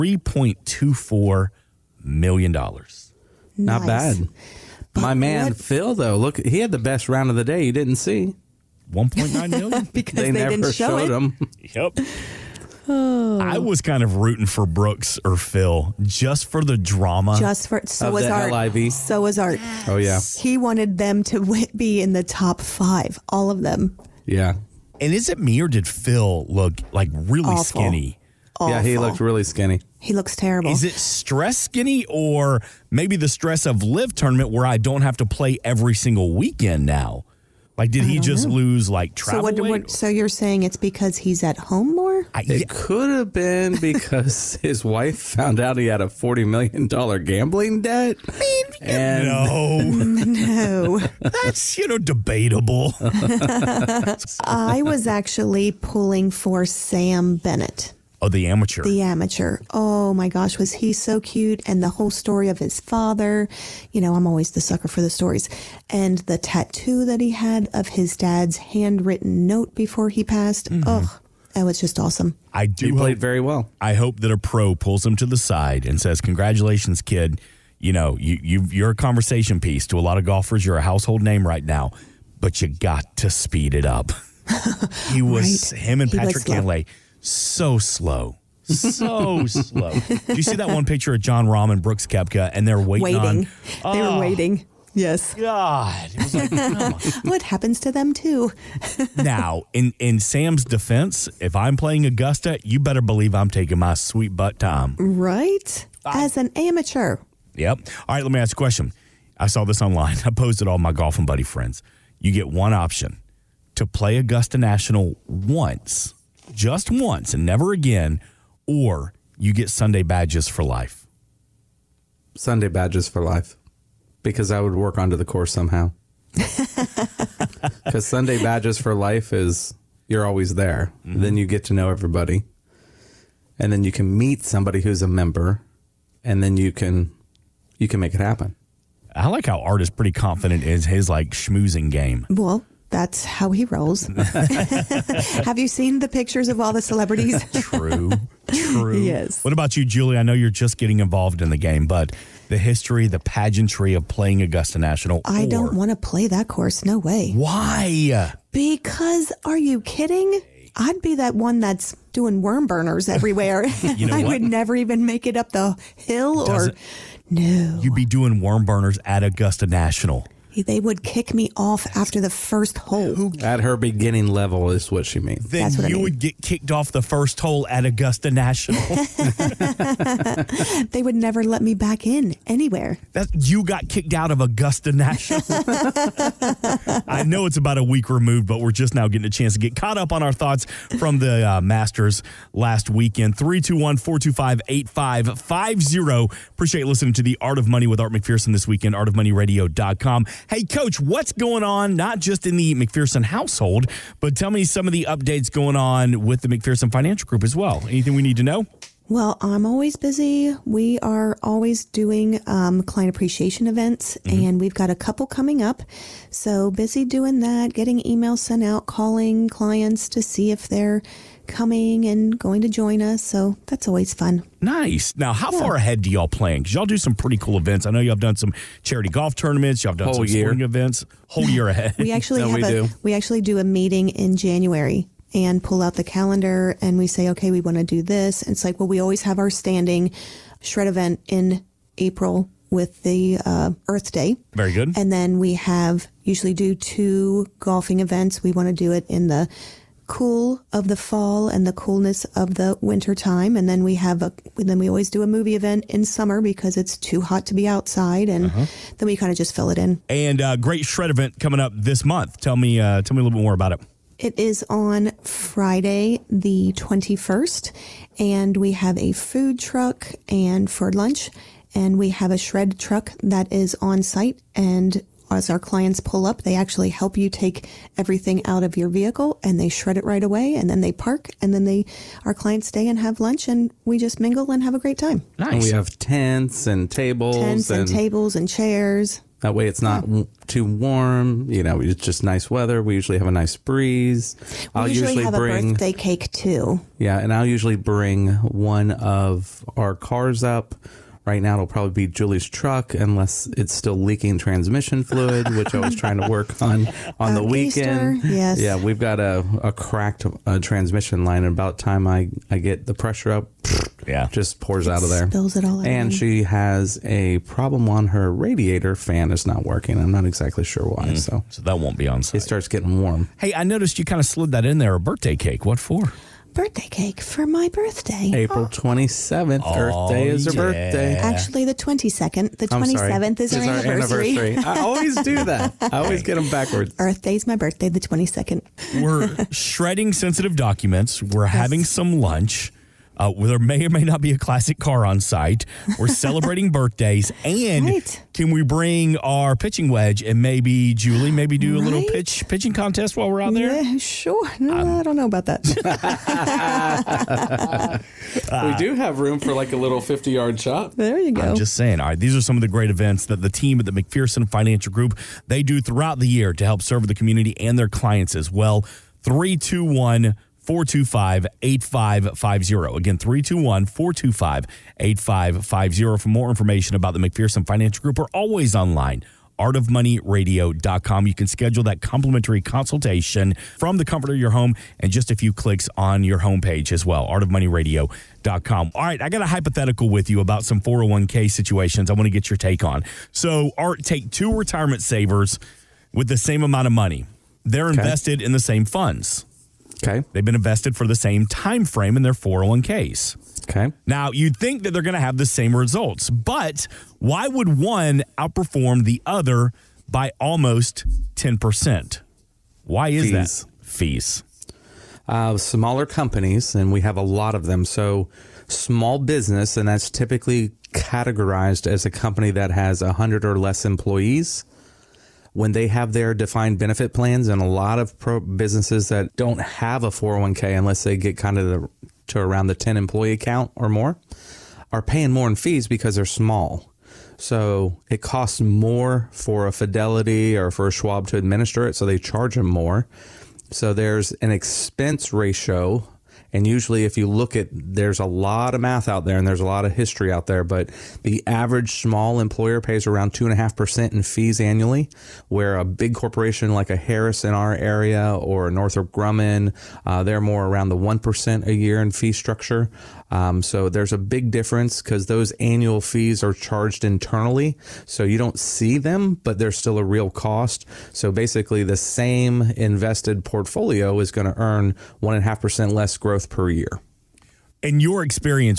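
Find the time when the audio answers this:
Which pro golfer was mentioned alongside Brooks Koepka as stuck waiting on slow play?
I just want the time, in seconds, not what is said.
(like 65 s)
91 s.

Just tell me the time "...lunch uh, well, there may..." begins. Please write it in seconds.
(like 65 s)
342 s.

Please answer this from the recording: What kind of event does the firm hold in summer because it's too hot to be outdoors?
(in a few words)
a movie event.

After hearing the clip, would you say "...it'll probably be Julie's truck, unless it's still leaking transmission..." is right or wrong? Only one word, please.
right.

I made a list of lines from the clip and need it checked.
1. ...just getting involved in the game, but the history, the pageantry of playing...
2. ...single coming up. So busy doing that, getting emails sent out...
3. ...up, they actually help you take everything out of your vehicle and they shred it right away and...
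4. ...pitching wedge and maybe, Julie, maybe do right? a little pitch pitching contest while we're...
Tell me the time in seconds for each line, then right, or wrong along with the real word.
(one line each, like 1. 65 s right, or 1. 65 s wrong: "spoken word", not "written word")
1. 150 s right
2. 214 s wrong: "couple", not "single"
3. 276 s right
4. 349 s right.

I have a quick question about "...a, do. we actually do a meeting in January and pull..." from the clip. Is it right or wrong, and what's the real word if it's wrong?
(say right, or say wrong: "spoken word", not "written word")
right.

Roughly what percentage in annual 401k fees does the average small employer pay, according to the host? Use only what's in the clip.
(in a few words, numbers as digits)
2.5%.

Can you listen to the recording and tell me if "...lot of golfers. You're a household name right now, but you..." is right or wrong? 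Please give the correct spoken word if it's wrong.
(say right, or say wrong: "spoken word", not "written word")
right.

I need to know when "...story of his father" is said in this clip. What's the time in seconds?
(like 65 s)
62 s.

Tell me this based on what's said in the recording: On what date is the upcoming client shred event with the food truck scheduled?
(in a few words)
Friday, the 21st.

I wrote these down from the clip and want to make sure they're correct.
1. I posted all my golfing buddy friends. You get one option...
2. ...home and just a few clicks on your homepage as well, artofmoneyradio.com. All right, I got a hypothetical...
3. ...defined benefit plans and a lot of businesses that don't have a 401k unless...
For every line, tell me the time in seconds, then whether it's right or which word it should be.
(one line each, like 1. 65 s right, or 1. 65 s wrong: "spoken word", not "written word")
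1. 110 s right
2. 384 s right
3. 426 s right.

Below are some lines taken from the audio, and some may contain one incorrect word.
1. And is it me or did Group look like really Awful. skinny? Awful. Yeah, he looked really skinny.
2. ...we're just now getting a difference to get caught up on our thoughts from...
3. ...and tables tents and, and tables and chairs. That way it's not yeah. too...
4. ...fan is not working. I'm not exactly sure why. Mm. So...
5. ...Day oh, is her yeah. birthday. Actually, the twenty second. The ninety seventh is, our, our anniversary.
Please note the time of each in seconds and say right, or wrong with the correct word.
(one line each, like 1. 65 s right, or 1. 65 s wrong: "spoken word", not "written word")
1. 25 s wrong: "Phil", not "Group"
2. 188 s wrong: "chance", not "difference"
3. 286 s right
4. 318 s right
5. 330 s wrong: "twenty", not "ninety".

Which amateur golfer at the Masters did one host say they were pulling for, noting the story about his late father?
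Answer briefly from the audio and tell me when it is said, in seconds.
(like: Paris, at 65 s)
Sam Bennett, at 56 s.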